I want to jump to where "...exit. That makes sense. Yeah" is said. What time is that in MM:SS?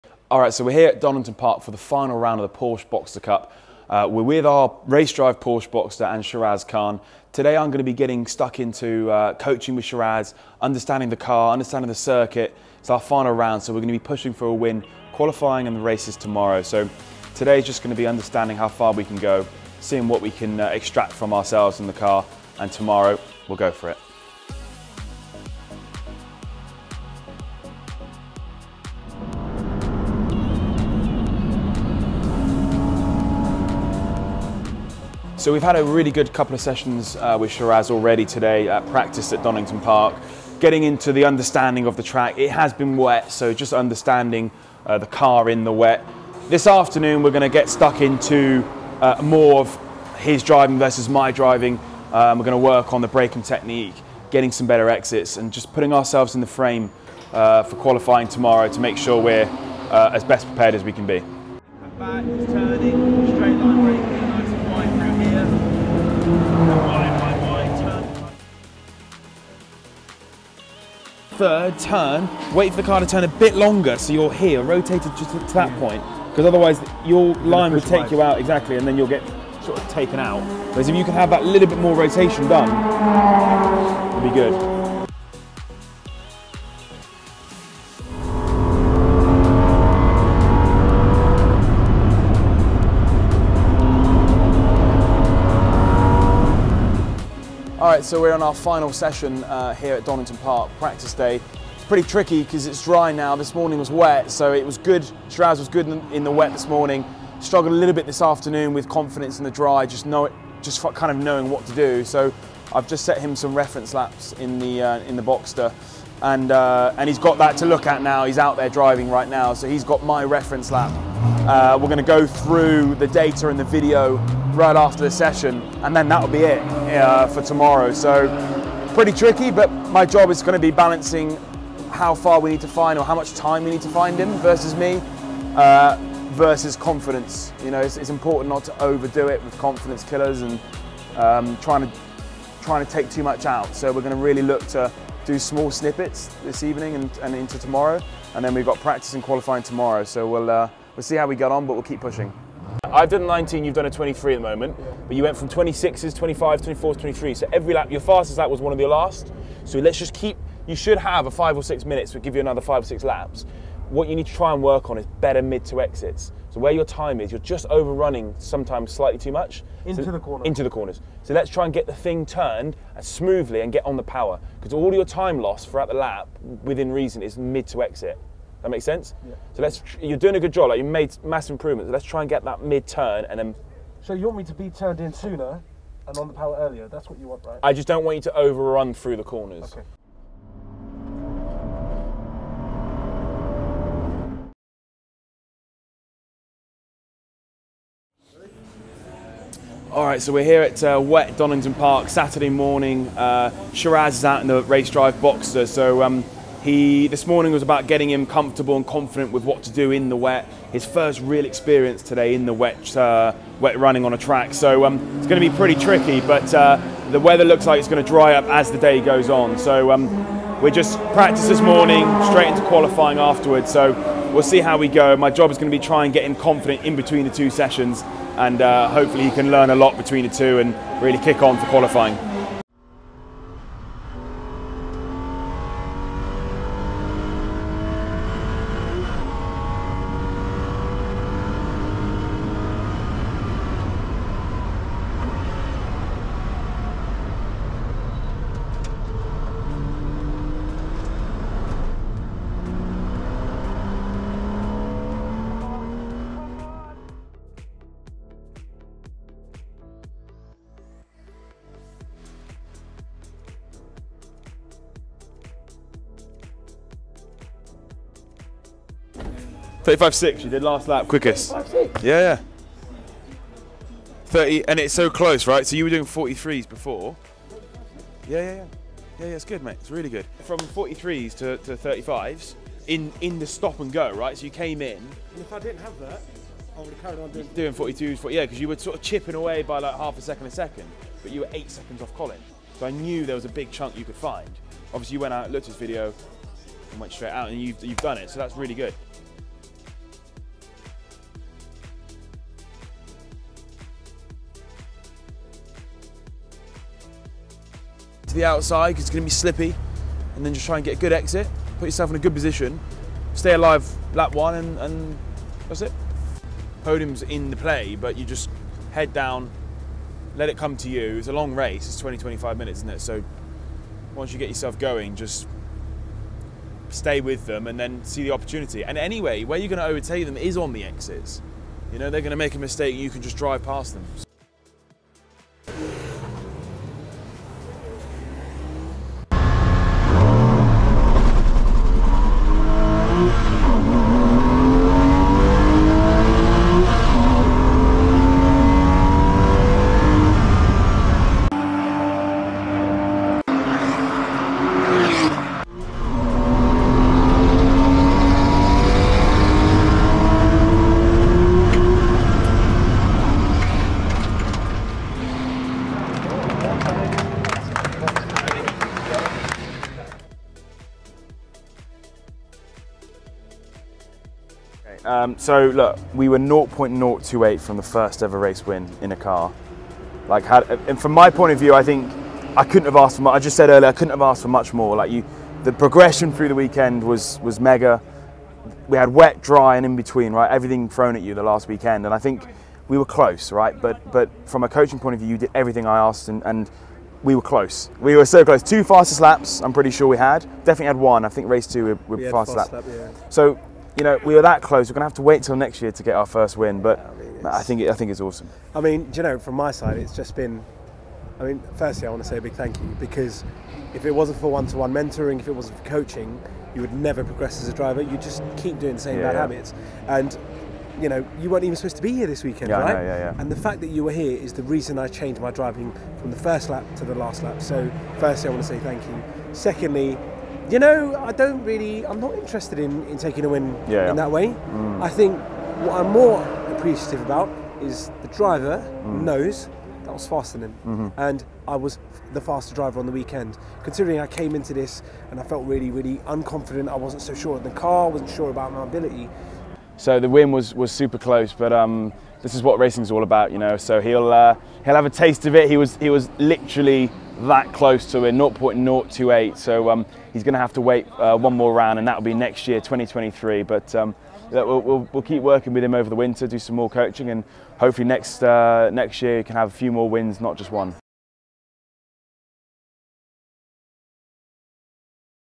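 02:57.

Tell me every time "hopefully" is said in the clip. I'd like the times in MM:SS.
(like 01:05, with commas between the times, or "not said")
03:48, 07:47.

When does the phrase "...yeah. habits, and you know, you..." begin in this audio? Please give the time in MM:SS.
06:59.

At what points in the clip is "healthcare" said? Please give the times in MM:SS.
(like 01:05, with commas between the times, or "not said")
not said.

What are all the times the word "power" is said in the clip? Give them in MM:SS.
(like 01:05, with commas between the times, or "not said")
02:54, 03:06.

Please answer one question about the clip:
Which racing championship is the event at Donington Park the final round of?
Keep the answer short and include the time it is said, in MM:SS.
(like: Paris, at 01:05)
Porsche Boxster Cup, at 00:02.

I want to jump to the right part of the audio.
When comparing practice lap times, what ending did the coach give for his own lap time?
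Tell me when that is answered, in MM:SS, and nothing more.
02:33.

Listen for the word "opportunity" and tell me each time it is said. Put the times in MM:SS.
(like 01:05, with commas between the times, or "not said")
05:28.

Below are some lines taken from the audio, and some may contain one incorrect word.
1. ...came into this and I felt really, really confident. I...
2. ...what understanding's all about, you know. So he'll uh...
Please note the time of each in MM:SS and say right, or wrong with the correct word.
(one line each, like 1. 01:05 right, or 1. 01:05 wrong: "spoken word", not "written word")
1. 07:24 wrong: "unconfident", not "confident"
2. 07:32 wrong: "racing", not "understanding".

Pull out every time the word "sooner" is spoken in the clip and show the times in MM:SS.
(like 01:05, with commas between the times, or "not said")
03:05.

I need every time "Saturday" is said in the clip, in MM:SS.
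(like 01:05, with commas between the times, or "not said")
03:22.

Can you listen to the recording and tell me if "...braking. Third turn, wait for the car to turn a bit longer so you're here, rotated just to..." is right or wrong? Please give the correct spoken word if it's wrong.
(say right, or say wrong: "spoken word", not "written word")
right.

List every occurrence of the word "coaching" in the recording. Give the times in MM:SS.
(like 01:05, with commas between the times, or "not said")
00:09, 06:34, 06:55, 07:46.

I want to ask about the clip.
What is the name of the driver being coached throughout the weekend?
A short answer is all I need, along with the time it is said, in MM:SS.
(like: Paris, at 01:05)
Shiraz Khan, at 00:06.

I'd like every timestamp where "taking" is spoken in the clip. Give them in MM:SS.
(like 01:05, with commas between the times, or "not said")
07:13.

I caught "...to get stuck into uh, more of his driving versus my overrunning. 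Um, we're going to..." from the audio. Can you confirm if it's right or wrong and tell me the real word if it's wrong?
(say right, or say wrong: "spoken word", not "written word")
wrong: "driving", not "overrunning".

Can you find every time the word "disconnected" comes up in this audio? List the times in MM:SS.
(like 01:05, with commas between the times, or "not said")
not said.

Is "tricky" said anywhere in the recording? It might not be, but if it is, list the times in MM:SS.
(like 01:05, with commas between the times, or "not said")
01:42, 02:09, 03:35.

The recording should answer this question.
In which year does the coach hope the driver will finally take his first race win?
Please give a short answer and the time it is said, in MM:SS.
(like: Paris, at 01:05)
2023, at 07:42.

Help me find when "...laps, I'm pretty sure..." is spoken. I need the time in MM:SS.
06:39.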